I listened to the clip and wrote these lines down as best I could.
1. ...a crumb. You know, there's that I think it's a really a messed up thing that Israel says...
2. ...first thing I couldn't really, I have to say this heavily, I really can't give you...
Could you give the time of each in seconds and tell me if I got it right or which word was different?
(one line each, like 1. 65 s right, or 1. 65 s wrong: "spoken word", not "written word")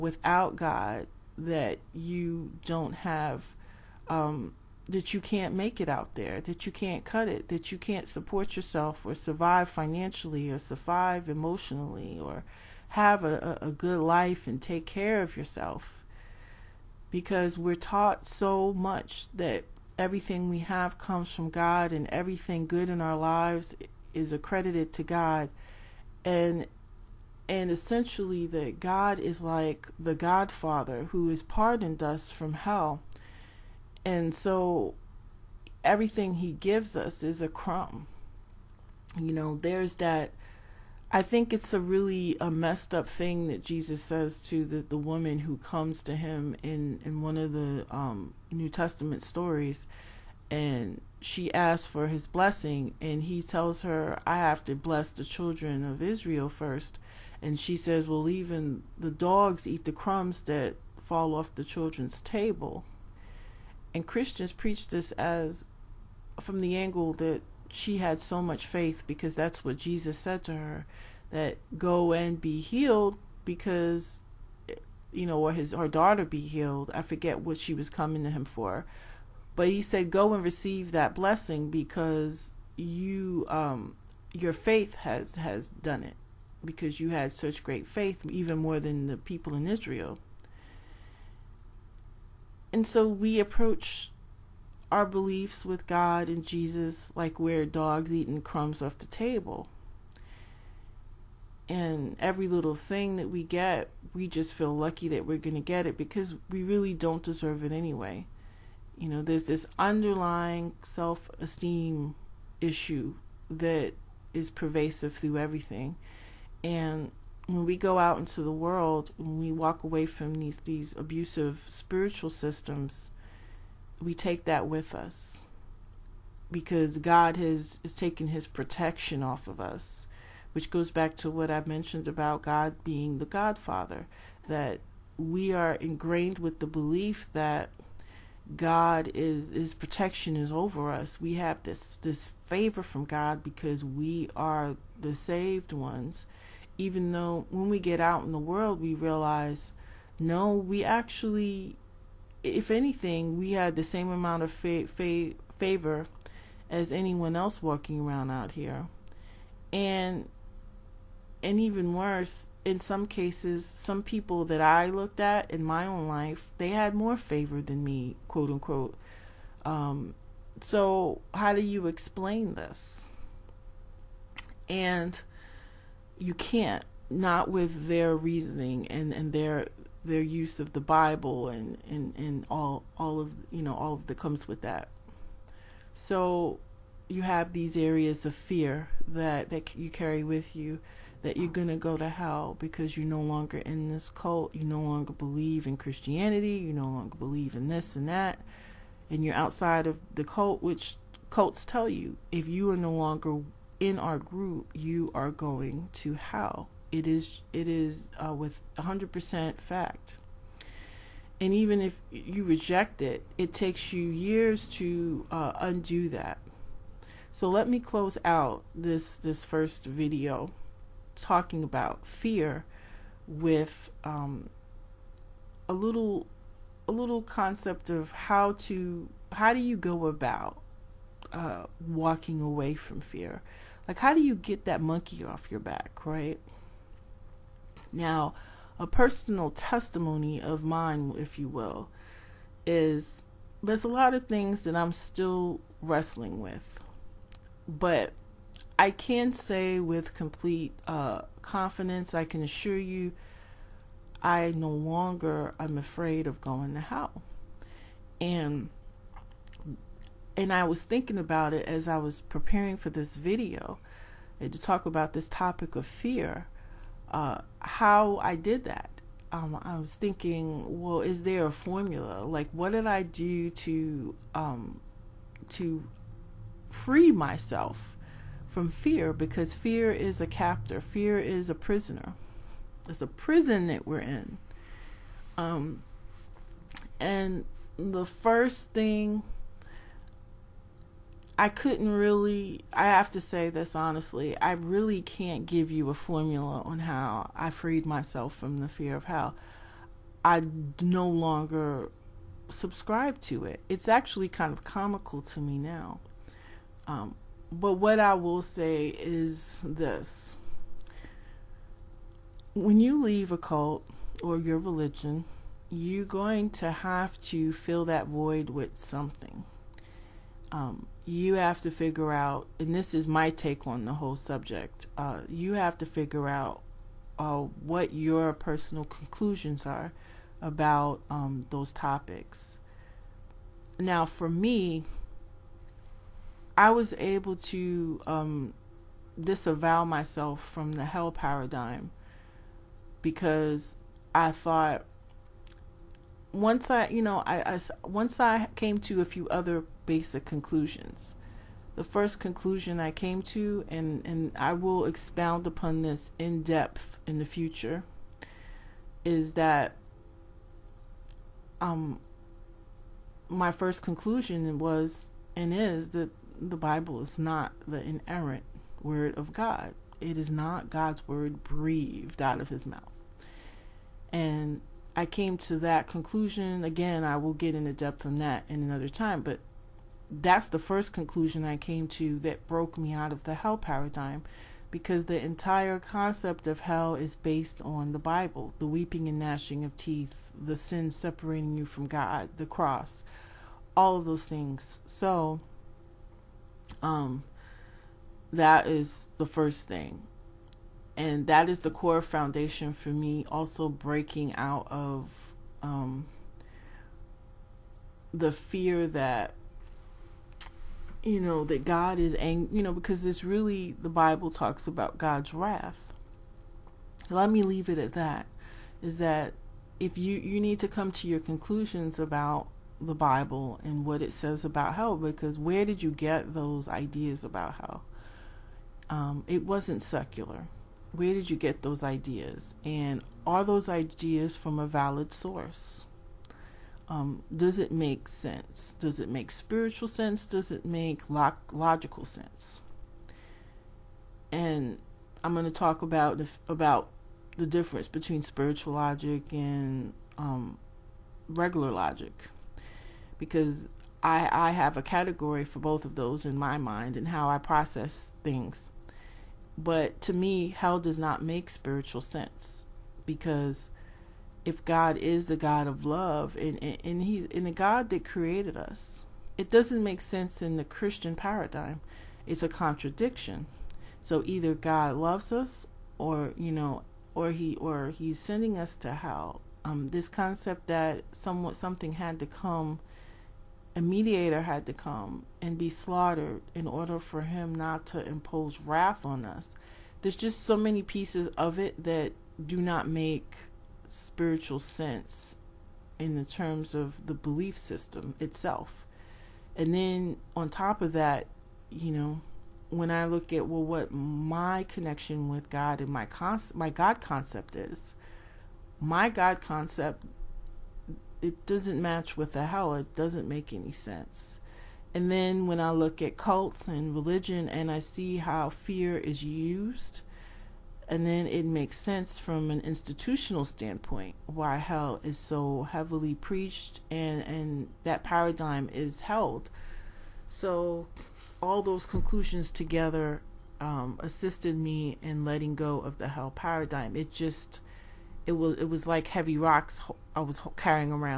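1. 37 s wrong: "Jesus", not "Israel"
2. 288 s wrong: "honestly", not "heavily".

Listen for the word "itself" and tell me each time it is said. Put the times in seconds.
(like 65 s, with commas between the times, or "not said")
498 s.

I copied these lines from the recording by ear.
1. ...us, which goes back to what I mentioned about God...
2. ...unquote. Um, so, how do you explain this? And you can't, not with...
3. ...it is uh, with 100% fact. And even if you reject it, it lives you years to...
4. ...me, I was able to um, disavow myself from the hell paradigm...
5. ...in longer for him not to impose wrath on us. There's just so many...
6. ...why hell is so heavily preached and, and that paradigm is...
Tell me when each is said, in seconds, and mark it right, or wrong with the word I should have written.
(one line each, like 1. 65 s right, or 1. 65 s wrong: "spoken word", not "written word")
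1. 129 s right
2. 168 s right
3. 207 s wrong: "takes", not "lives"
4. 334 s right
5. 486 s wrong: "order", not "longer"
6. 524 s right.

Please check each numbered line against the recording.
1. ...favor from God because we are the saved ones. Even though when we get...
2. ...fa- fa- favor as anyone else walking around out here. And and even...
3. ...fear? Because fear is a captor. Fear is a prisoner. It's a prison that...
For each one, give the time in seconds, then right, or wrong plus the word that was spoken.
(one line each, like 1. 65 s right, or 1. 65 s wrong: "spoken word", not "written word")
1. 142 s right
2. 154 s right
3. 278 s right.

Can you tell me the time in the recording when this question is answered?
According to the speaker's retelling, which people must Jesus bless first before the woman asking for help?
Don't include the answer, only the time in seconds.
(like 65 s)
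55 s.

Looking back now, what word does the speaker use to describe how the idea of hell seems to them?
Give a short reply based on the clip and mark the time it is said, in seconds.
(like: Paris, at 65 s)
Comical, at 304 s.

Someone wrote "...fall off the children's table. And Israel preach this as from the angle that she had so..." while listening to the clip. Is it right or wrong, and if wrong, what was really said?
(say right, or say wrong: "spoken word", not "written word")
wrong: "Christians", not "Israel".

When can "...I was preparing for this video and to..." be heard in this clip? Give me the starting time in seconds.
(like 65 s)
261 s.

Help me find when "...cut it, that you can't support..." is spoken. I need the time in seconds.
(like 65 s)
7 s.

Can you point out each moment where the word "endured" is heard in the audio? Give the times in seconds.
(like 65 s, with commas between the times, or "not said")
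not said.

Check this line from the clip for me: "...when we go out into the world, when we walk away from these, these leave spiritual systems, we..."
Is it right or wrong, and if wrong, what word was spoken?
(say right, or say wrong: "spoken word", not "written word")
wrong: "abusive", not "leave".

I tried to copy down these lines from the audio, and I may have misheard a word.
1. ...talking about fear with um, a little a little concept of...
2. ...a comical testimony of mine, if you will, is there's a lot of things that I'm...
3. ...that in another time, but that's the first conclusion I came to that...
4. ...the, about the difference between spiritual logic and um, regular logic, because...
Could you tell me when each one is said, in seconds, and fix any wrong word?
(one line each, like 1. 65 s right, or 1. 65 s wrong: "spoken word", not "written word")
1. 221 s right
2. 238 s wrong: "personal", not "comical"
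3. 378 s right
4. 446 s right.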